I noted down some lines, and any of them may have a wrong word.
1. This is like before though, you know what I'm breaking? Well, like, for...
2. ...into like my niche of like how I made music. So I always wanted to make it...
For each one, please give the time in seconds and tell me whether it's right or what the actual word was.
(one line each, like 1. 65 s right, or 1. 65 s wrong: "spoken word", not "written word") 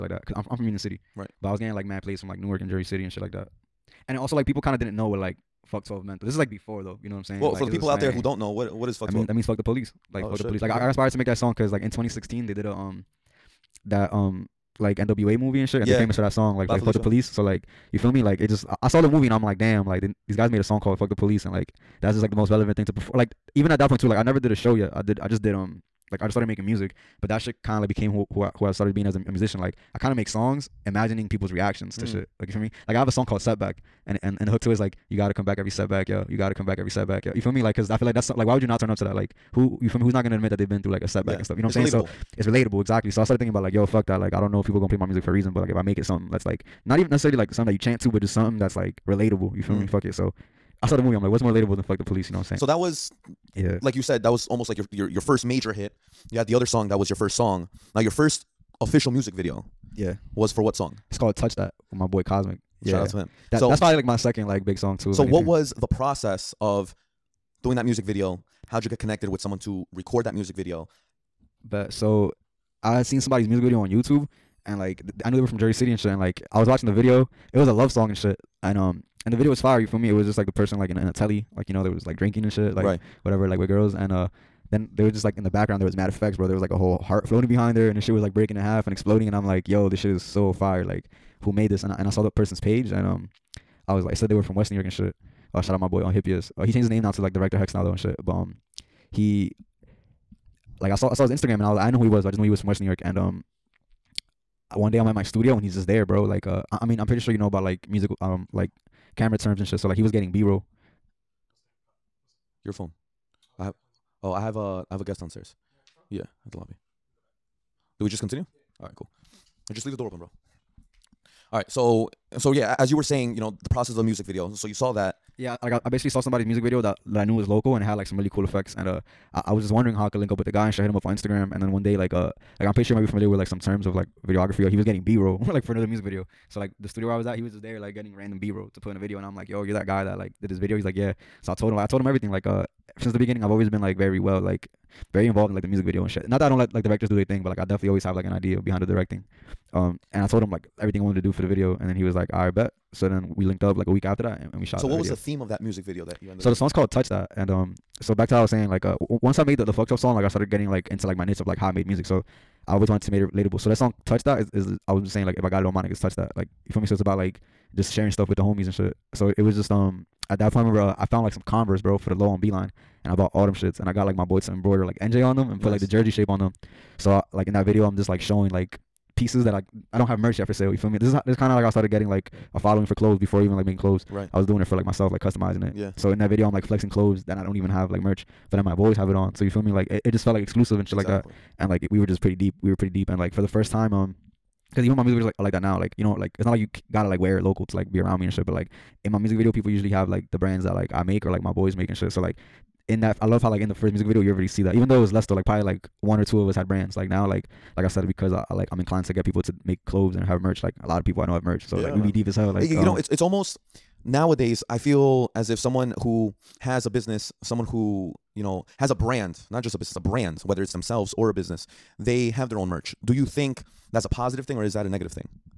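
1. 6 s wrong: "saying", not "breaking"
2. 160 s right.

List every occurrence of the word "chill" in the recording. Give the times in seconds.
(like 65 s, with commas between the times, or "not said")
not said.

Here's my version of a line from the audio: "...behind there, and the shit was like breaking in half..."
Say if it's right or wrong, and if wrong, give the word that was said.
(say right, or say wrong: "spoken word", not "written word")
right.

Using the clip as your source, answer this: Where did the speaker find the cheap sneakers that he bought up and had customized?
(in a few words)
Beeline.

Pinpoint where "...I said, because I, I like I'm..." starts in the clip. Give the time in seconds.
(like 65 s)
207 s.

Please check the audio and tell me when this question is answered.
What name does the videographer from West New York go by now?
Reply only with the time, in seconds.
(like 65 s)
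97 s.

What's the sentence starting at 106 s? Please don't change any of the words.
Like uh, I, I mean I'm pretty sure you know about like music um like camera terms and shit.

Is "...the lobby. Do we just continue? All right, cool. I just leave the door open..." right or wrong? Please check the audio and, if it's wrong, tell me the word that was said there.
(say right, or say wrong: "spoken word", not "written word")
right.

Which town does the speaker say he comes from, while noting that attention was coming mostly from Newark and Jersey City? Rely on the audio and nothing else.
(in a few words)
Union City.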